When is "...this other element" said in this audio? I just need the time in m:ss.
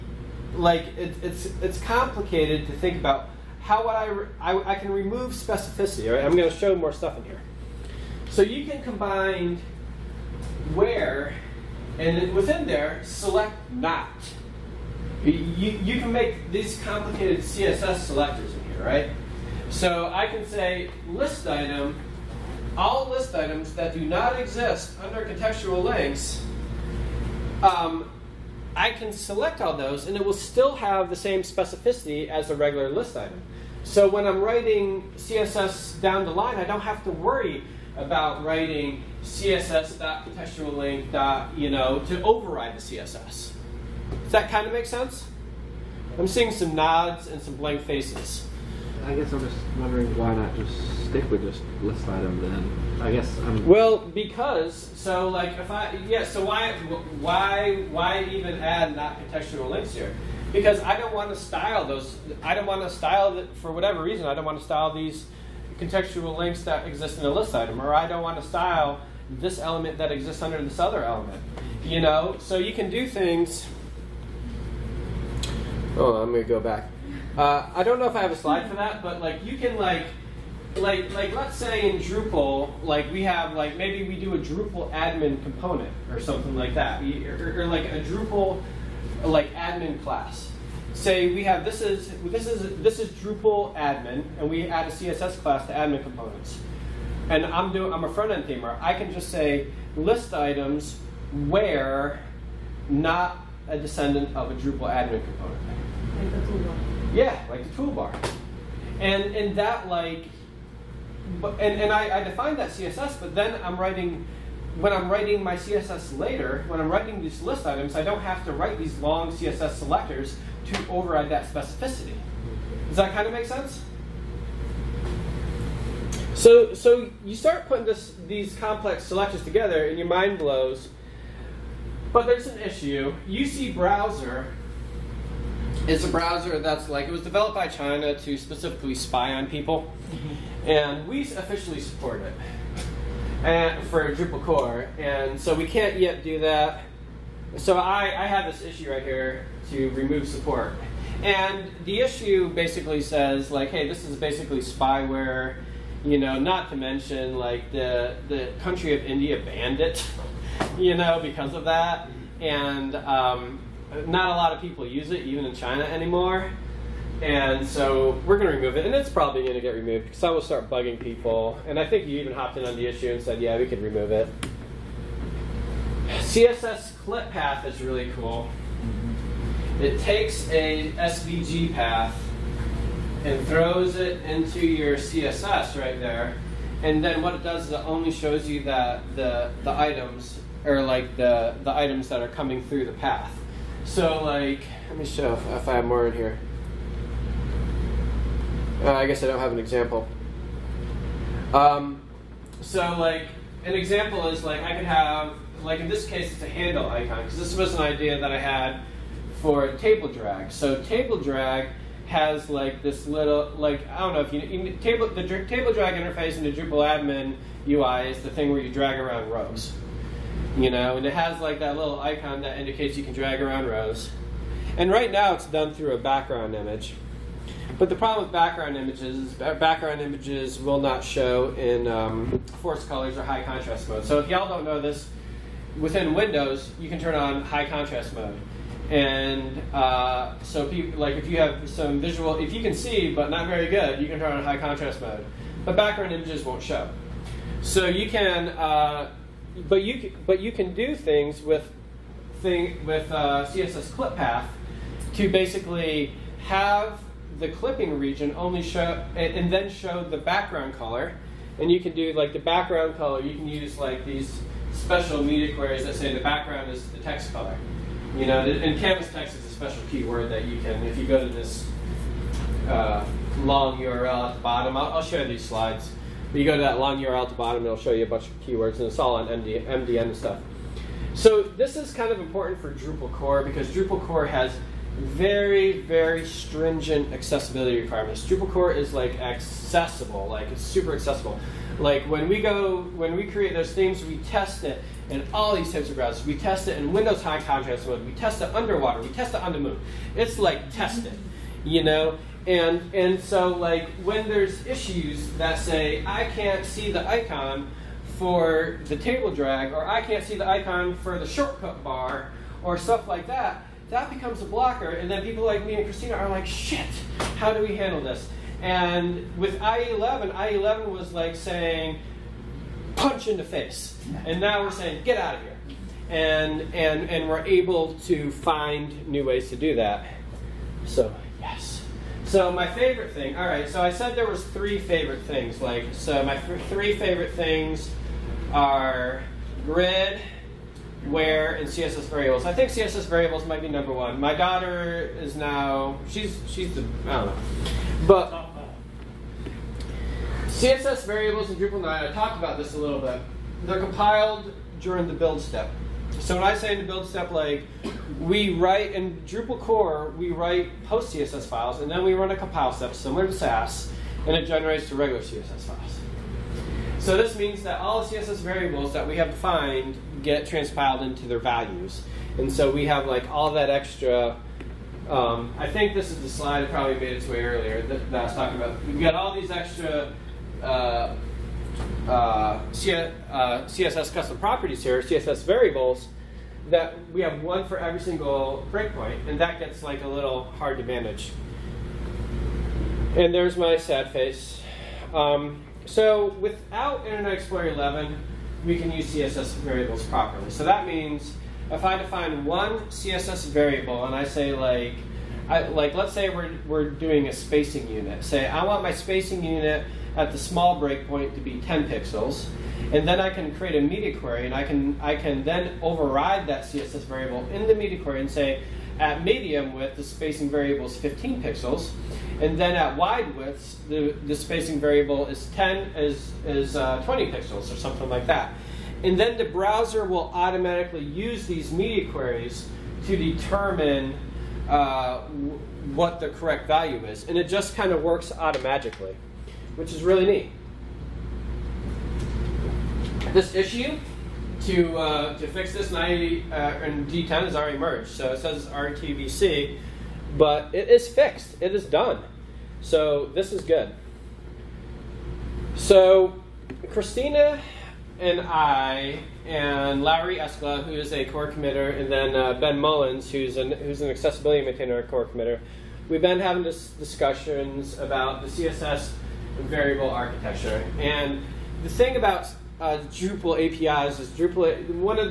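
1:10.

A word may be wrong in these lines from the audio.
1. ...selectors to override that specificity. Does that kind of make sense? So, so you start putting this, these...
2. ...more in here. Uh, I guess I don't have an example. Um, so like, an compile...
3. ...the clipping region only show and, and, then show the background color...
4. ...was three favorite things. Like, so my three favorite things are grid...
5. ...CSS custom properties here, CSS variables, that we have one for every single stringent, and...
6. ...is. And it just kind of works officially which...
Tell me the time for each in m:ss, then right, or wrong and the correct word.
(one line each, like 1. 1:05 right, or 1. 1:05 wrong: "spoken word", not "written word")
1. 1:59 right
2. 3:15 wrong: "example", not "compile"
3. 4:17 right
4. 5:34 right
5. 6:22 wrong: "breakpoint", not "stringent"
6. 7:17 wrong: "automatically", not "officially".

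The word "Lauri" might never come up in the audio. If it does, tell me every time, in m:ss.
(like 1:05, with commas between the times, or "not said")
7:40.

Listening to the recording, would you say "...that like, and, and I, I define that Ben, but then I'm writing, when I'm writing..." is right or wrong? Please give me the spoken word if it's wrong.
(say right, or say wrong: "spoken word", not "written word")
wrong: "CSS", not "Ben".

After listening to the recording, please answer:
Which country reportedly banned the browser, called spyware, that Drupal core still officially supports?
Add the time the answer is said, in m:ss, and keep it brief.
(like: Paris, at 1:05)
India, at 2:39.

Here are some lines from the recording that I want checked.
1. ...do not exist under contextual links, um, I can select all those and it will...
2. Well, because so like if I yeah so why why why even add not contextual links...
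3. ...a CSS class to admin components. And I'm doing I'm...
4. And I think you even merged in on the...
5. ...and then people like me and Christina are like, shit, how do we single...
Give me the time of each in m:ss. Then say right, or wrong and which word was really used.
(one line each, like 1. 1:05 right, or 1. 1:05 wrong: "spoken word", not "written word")
1. 0:23 right
2. 0:53 right
3. 1:34 right
4. 2:51 wrong: "hopped", not "merged"
5. 5:14 wrong: "handle", not "single".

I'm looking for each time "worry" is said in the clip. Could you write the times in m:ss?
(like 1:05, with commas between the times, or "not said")
0:37.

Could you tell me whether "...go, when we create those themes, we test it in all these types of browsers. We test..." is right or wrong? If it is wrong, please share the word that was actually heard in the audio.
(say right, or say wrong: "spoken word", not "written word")
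right.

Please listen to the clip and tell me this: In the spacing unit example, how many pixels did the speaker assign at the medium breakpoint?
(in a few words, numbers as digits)
15.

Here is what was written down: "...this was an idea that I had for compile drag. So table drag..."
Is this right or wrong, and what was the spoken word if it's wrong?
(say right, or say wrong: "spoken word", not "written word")
wrong: "table", not "compile".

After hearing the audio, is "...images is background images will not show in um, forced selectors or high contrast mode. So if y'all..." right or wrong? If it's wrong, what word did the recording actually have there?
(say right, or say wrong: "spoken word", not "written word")
wrong: "colors", not "selectors".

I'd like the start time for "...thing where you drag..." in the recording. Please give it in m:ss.
3:38.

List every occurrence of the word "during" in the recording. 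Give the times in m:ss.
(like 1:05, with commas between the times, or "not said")
5:54.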